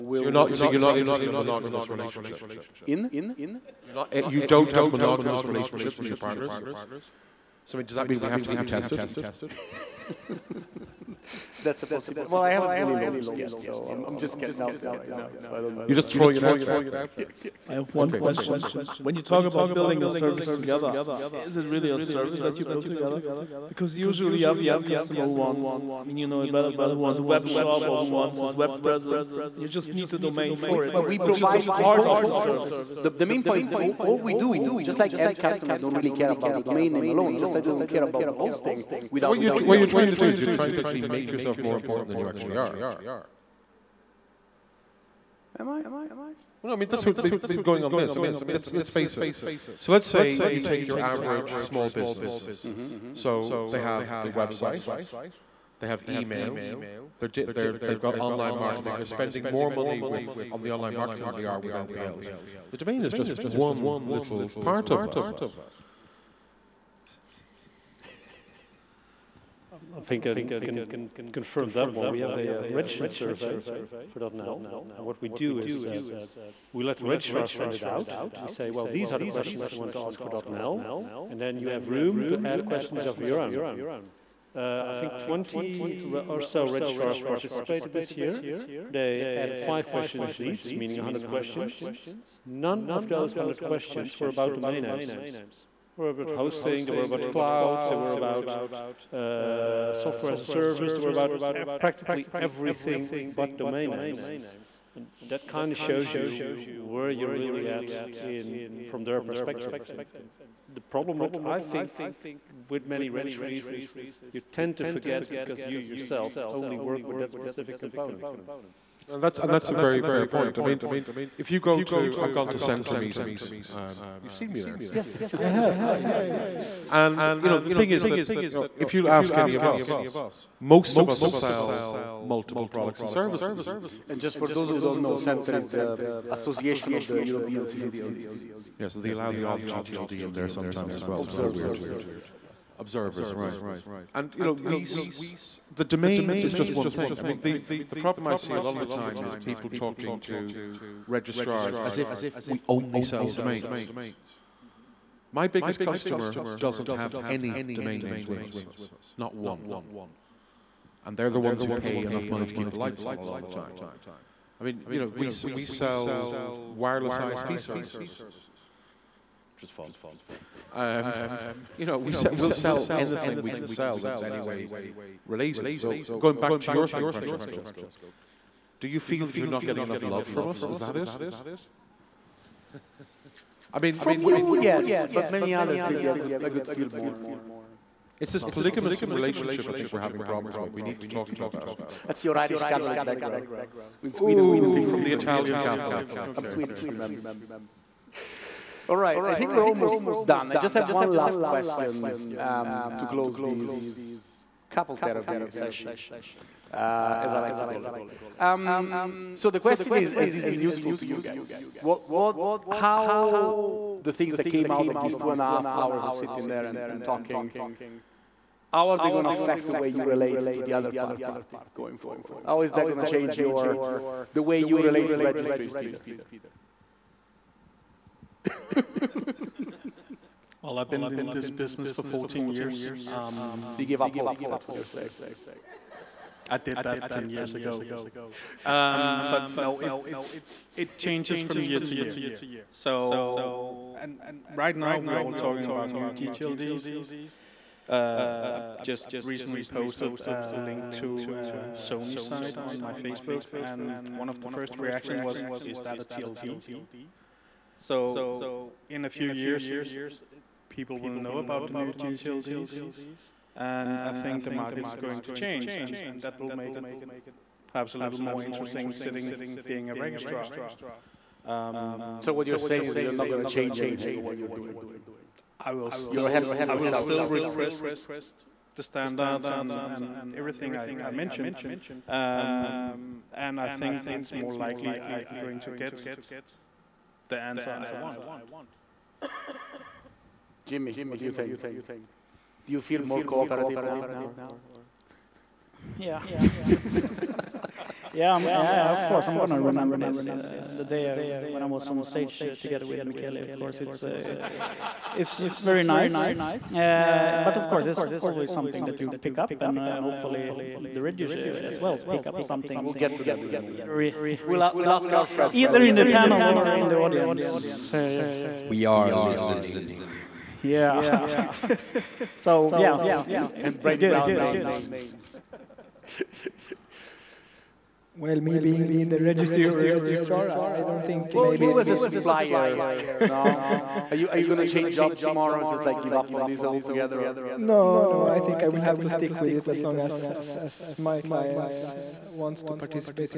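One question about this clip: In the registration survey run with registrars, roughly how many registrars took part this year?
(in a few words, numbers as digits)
20.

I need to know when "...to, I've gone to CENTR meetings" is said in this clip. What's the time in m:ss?
2:01.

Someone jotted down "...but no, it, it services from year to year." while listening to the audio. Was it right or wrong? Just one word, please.
wrong.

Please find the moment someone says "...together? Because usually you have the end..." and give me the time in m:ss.
0:22.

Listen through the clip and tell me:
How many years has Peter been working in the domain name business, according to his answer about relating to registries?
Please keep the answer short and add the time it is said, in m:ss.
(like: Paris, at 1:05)
14, at 3:52.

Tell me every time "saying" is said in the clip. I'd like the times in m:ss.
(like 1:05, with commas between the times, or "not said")
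3:54, 4:32.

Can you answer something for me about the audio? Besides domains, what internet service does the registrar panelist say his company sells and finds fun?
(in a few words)
wireless ISP services.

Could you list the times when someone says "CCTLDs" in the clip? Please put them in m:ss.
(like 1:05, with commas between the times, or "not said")
2:17.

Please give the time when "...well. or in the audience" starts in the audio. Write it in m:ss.
5:16.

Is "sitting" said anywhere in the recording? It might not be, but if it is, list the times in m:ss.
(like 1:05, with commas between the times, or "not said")
3:36, 4:28.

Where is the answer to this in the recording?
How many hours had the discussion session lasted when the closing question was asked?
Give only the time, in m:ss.
3:35.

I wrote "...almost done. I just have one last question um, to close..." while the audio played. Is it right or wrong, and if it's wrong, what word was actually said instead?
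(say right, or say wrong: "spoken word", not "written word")
right.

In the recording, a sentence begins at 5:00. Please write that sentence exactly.
Uh, the day I, when I was on stage uh, together with Michele, of course, it's, uh, it's very nice.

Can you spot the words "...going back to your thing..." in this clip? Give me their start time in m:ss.
2:56.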